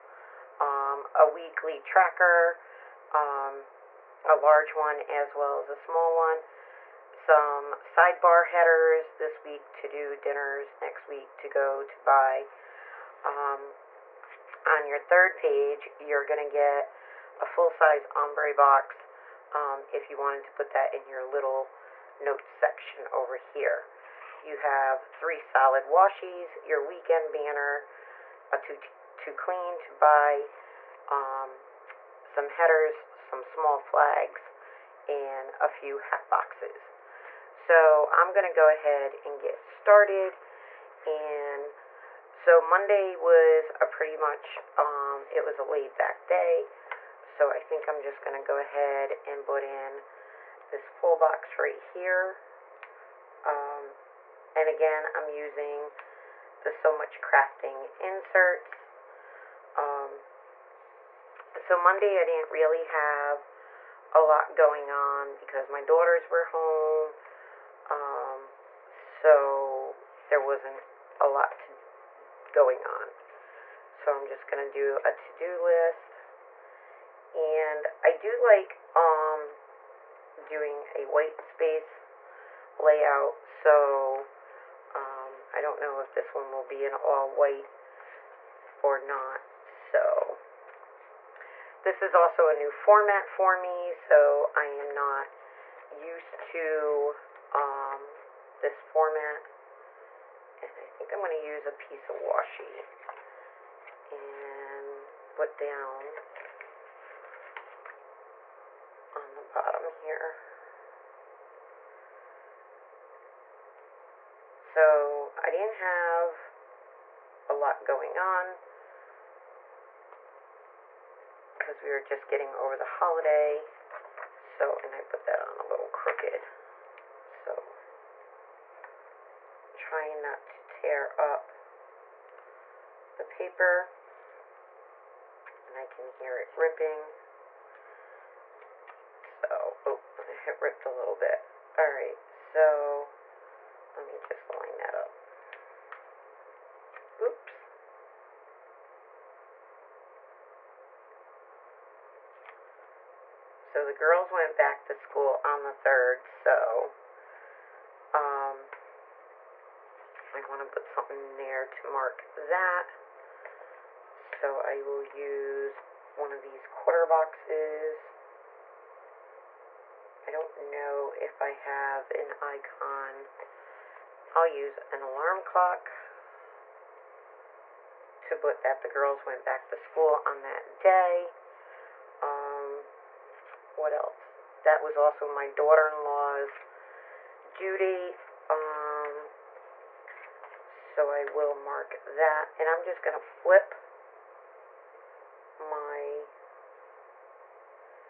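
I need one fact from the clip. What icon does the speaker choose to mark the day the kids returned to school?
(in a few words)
alarm clock.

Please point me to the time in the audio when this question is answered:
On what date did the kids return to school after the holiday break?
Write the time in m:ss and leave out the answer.
2:35.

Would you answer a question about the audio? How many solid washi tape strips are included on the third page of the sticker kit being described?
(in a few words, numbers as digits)
3.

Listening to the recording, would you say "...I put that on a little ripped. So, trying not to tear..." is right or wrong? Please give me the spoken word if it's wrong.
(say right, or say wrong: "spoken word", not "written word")
wrong: "crooked", not "ripped".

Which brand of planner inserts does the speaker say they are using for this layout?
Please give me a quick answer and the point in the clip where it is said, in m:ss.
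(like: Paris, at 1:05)
So Much Crafting, at 0:56.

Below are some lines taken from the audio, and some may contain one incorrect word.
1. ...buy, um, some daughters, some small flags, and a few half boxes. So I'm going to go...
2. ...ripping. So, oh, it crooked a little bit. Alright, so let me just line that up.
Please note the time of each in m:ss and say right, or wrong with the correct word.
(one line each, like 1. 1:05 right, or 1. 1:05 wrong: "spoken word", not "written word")
1. 0:29 wrong: "headers", not "daughters"
2. 2:16 wrong: "ripped", not "crooked".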